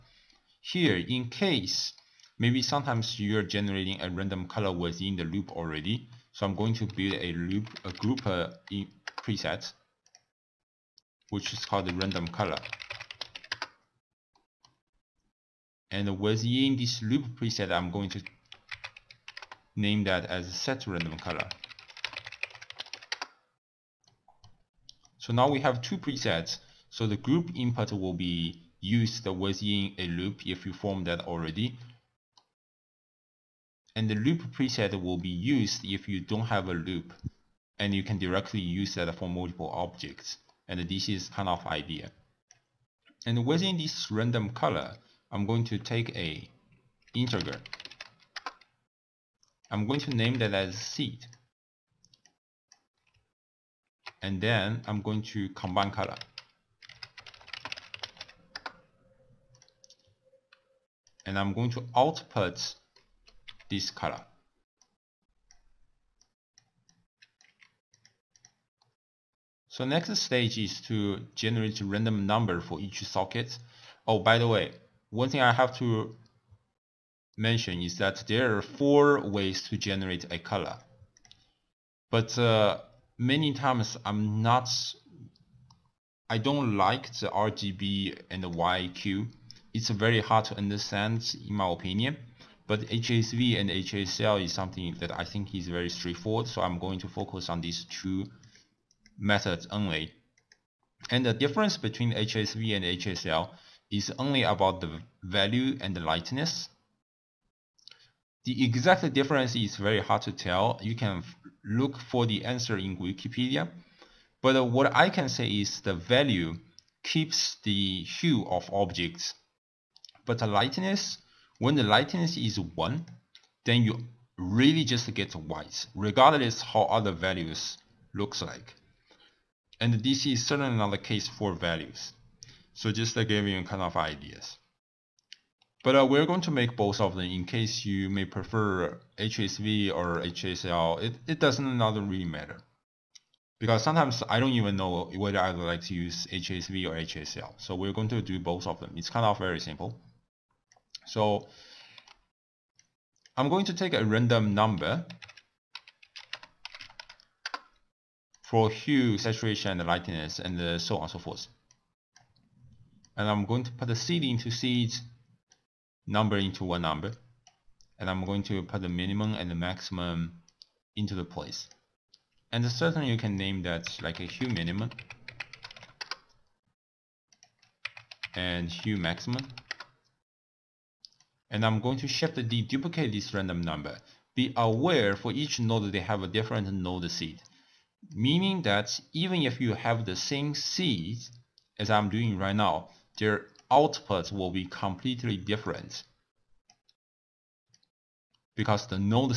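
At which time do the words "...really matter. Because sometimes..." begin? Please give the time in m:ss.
2:22.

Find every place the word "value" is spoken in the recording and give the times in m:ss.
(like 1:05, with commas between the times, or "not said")
1:45, 1:55, 2:07, 2:11.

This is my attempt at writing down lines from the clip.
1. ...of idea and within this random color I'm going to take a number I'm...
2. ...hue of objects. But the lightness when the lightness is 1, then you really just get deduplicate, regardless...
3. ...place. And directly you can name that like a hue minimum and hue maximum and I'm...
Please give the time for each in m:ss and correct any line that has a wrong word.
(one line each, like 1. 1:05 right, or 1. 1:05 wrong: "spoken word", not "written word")
1. 0:41 wrong: "integer", not "number"
2. 1:58 wrong: "white", not "deduplicate"
3. 2:51 wrong: "certainly", not "directly".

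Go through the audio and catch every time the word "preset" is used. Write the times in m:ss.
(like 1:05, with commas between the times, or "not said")
0:09, 0:17, 0:25, 0:34.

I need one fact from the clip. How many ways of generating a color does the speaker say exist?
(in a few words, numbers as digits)
4.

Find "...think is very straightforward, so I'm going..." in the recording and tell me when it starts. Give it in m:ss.
1:35.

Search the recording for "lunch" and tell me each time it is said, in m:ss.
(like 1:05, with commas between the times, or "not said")
not said.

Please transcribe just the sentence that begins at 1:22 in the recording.
But uh, many times I'm not, I don't like the RGB and the YIQ.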